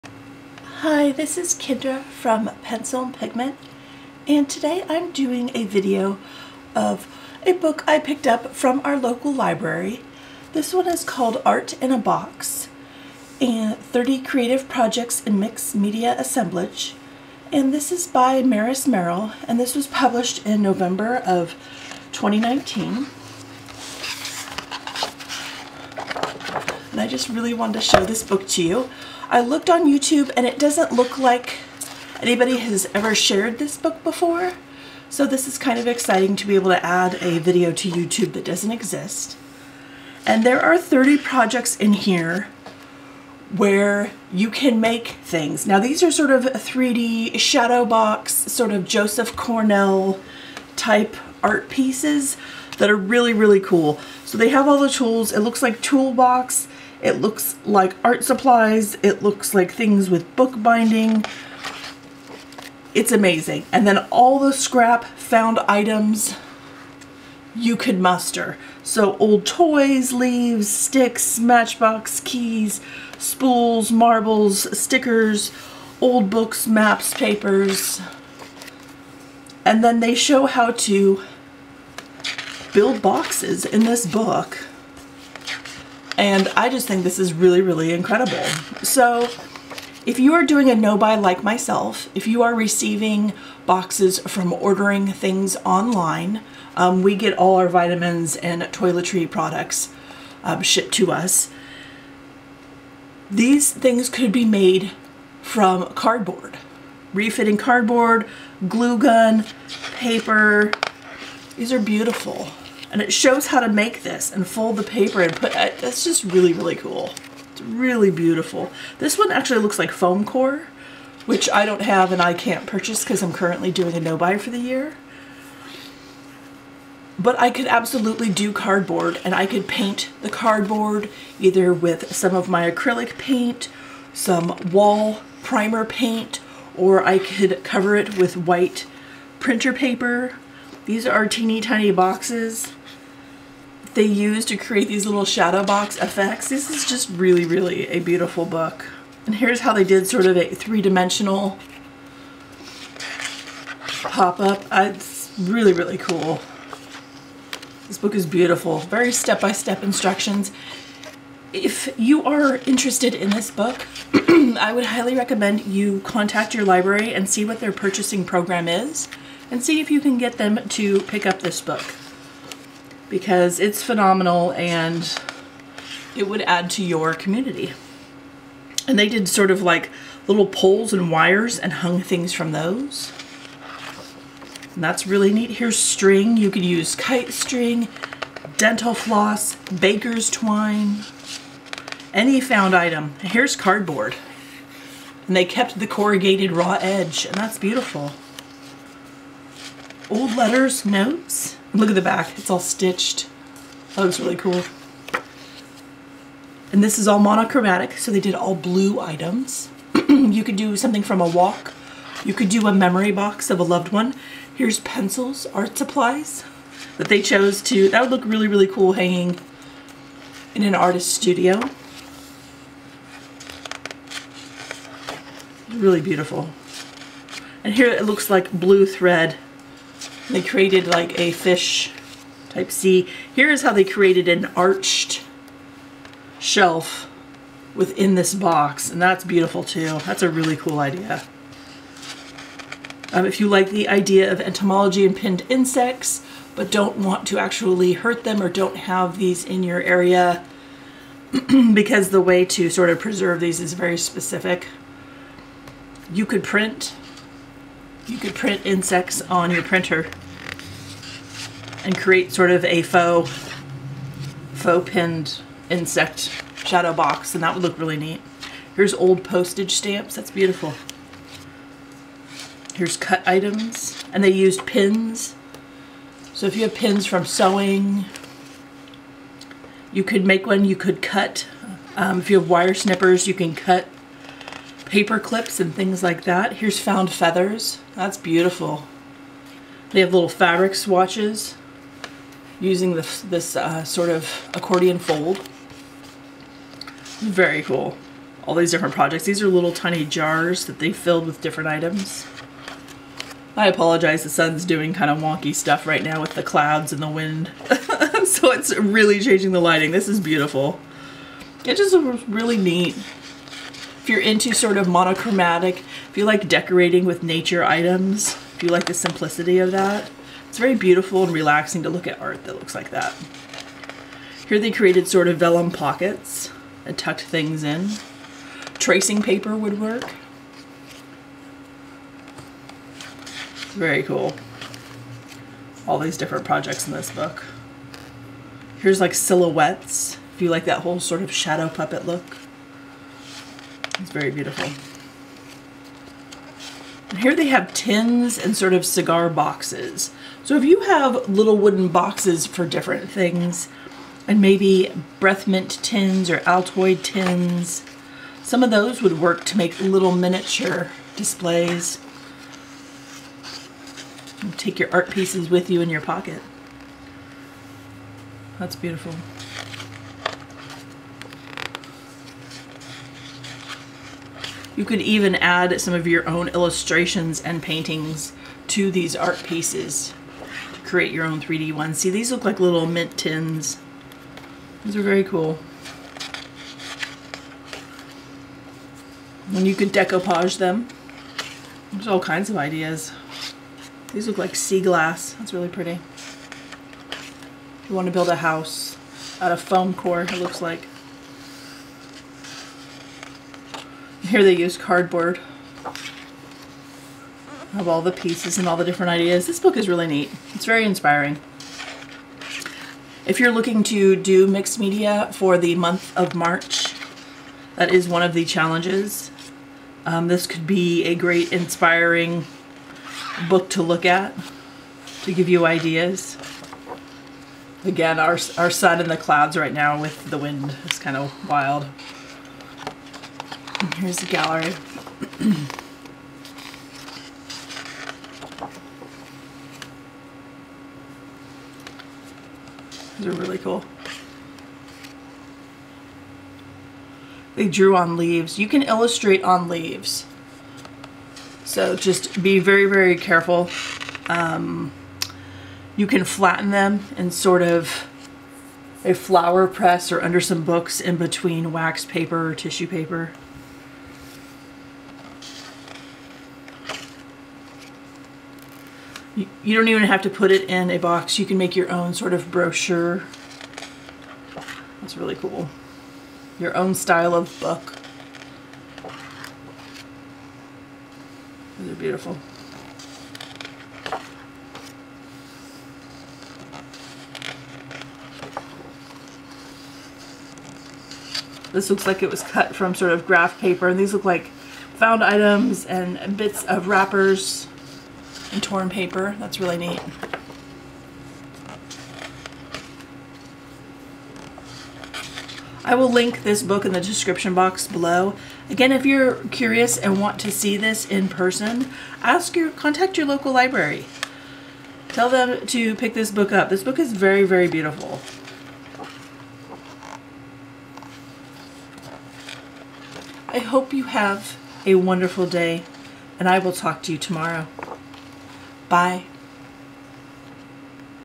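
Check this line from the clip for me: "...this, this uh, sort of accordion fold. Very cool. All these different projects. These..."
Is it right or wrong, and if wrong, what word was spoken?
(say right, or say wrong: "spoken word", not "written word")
right.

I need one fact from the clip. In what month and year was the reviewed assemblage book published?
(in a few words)
November 2019.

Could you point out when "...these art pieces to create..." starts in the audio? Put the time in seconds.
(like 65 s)
378 s.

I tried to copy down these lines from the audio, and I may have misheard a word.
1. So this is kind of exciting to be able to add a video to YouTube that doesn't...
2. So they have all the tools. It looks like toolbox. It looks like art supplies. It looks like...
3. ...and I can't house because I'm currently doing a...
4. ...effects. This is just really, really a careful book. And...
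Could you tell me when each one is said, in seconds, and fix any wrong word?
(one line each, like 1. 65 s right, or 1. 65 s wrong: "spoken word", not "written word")
1. 35 s right
2. 54 s right
3. 122 s wrong: "purchase", not "house"
4. 145 s wrong: "beautiful", not "careful".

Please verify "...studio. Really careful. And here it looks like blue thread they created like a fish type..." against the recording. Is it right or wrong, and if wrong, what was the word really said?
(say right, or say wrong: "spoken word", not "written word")
wrong: "beautiful", not "careful".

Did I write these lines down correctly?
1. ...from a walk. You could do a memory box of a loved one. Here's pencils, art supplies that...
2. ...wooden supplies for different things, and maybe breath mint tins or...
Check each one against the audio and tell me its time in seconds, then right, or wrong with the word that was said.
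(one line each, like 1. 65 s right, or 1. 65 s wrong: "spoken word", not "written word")
1. 211 s right
2. 351 s wrong: "boxes", not "supplies".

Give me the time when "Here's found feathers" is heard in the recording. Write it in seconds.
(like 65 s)
286 s.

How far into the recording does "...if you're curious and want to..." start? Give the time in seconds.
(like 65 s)
508 s.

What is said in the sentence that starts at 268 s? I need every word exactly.
Here's old postage stamps, that's beautiful.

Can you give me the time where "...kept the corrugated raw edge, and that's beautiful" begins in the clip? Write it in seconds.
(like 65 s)
195 s.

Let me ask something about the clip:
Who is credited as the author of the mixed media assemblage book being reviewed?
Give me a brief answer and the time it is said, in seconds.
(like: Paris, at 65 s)
Maris Merrill, at 18 s.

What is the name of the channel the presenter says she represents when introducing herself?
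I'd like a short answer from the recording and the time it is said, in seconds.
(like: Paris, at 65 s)
Pencil and Pigment, at 2 s.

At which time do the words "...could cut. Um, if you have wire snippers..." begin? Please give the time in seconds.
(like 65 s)
280 s.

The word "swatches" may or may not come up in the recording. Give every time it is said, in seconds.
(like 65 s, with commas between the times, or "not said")
290 s.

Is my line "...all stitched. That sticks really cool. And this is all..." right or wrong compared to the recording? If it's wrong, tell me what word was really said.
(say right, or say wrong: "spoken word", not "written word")
wrong: "looks", not "sticks".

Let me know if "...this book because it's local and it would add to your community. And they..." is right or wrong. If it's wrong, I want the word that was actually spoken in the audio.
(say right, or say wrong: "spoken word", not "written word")
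wrong: "phenomenal", not "local".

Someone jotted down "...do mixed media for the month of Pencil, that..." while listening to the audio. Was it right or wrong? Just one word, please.
wrong.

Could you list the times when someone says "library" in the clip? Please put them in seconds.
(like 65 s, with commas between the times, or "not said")
9 s, 166 s, 513 s.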